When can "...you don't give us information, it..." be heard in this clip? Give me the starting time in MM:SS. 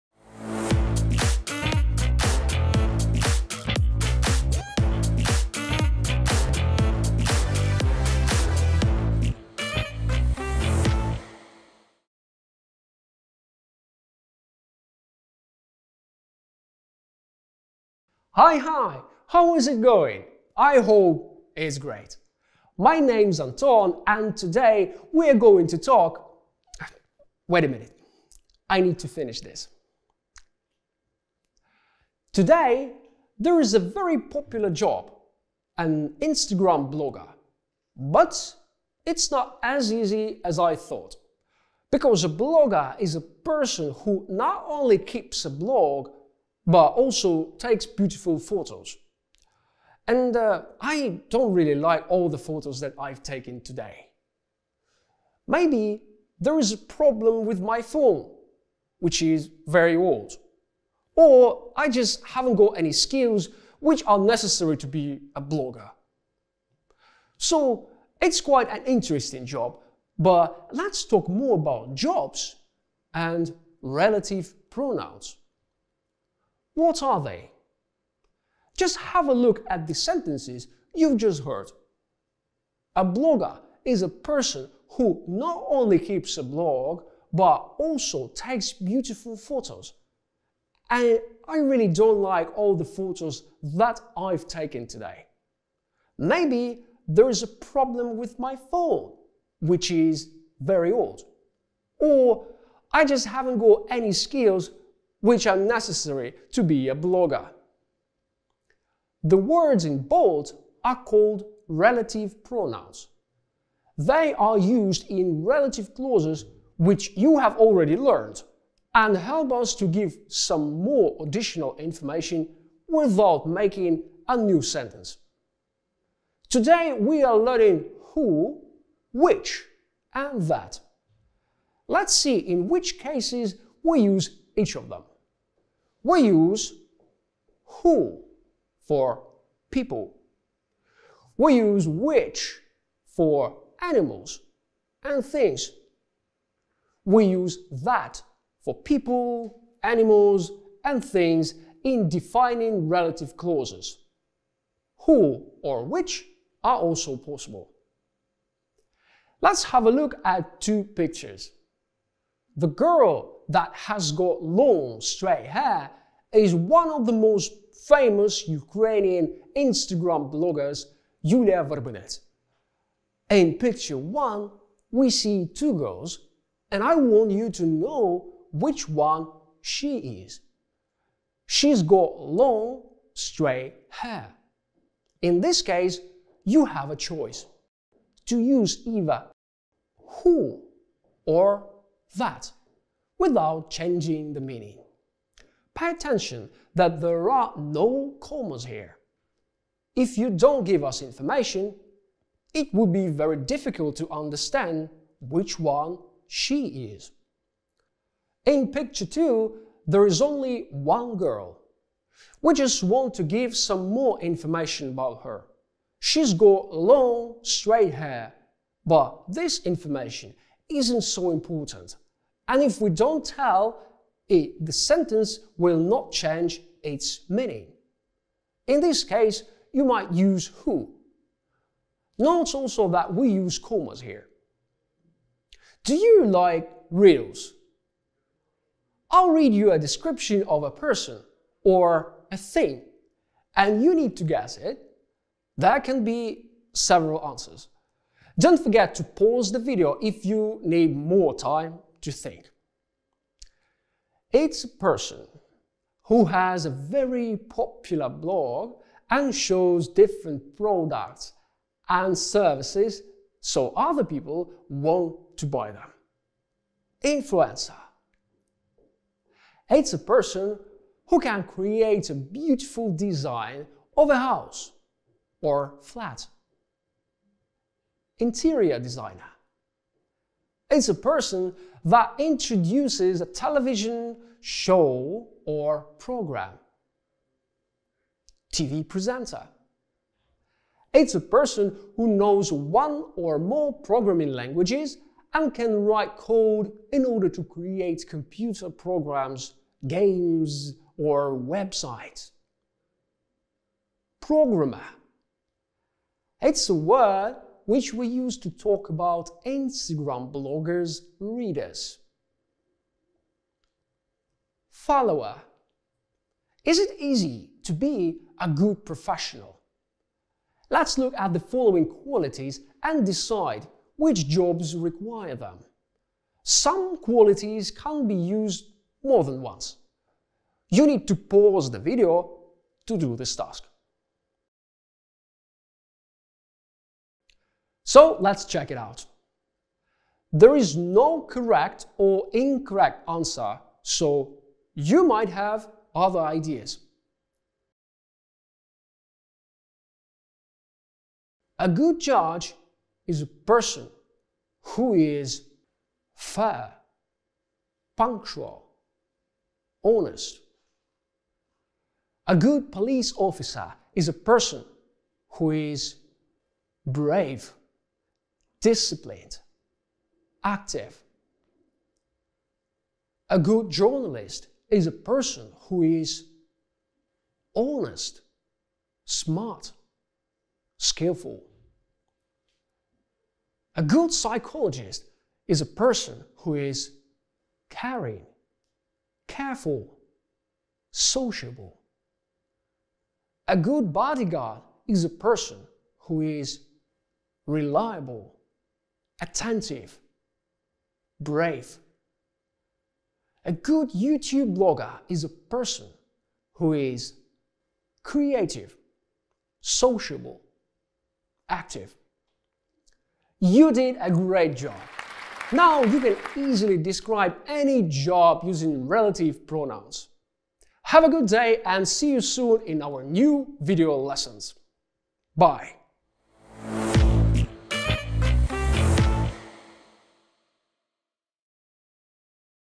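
03:20.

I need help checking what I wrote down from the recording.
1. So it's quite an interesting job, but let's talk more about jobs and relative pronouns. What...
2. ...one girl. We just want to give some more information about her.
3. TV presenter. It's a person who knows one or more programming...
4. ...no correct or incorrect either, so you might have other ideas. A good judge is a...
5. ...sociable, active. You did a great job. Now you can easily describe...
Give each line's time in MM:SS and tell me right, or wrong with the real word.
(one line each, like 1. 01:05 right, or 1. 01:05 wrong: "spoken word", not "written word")
1. 01:07 right
2. 03:30 right
3. 04:48 right
4. 05:40 wrong: "answer", not "either"
5. 06:49 right.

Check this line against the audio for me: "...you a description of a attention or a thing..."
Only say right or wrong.
wrong.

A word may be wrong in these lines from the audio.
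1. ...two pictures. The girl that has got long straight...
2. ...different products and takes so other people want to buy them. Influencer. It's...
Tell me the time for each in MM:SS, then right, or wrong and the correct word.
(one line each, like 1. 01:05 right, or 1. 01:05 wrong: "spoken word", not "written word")
1. 02:40 right
2. 04:19 wrong: "services", not "takes".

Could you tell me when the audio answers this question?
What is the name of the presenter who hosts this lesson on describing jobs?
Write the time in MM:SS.
00:23.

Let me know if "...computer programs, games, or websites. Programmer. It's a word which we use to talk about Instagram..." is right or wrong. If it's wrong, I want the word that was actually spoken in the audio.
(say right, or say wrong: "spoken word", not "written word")
right.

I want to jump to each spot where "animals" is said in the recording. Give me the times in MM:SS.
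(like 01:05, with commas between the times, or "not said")
02:23, 02:29.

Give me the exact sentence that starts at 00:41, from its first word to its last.
Because a blogger is a person who not only keeps a blog, but also takes beautiful photos.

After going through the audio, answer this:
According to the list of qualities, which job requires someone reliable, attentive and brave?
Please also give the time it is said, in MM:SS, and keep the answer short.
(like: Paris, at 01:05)
bodyguard, at 06:33.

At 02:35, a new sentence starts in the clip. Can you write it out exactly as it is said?
Who or which are also possible.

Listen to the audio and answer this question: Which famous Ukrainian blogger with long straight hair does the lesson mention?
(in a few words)
Yulia Verbenet.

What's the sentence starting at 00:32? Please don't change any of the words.
Today, there is a very popular job an Instagram blogger.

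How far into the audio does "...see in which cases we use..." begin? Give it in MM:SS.
02:12.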